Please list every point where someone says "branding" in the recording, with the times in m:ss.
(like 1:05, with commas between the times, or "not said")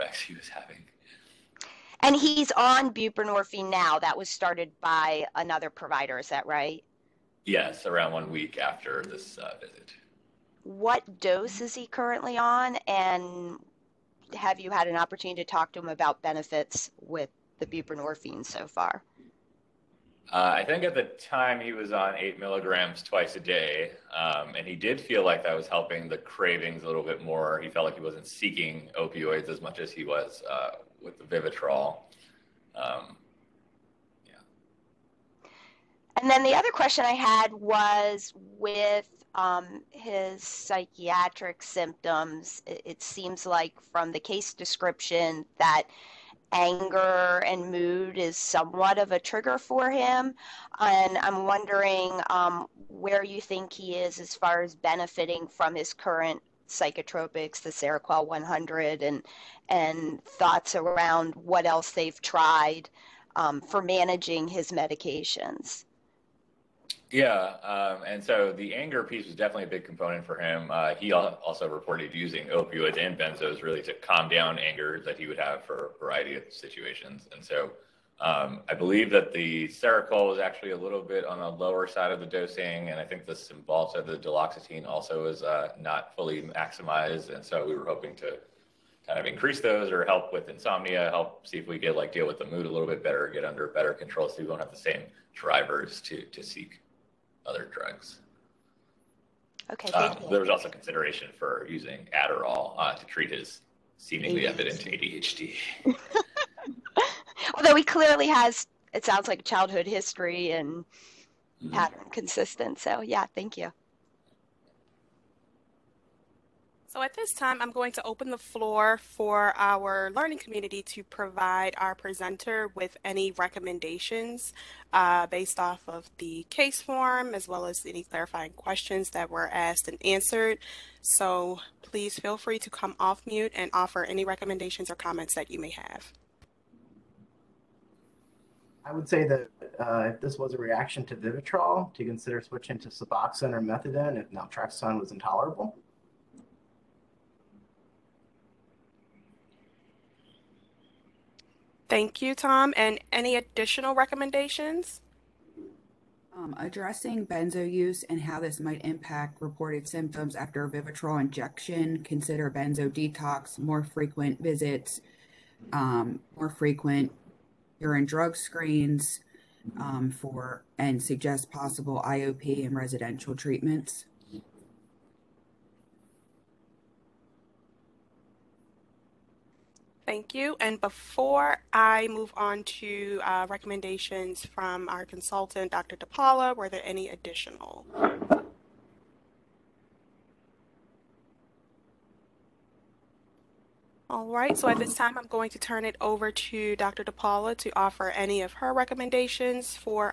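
not said.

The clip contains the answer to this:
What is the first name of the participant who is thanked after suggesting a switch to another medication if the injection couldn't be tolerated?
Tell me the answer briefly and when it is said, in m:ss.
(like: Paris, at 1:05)
Tom, at 2:32.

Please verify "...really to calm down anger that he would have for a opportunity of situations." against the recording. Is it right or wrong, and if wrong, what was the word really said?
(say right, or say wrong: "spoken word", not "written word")
wrong: "variety", not "opportunity".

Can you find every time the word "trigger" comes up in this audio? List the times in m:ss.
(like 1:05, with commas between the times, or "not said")
0:49.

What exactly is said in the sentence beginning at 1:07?
Yeah, um, and so the anger piece was definitely a big component for him.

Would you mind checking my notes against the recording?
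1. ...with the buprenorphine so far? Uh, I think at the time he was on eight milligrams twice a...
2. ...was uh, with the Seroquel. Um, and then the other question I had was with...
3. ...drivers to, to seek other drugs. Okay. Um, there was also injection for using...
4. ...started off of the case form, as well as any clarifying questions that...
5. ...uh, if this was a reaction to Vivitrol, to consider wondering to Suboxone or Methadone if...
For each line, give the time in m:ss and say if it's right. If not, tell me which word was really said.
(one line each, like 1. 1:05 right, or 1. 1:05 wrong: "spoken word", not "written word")
1. 0:17 right
2. 0:30 wrong: "Vivitrol", not "Seroquel"
3. 1:35 wrong: "consideration", not "injection"
4. 2:05 wrong: "based", not "started"
5. 2:19 wrong: "switching", not "wondering".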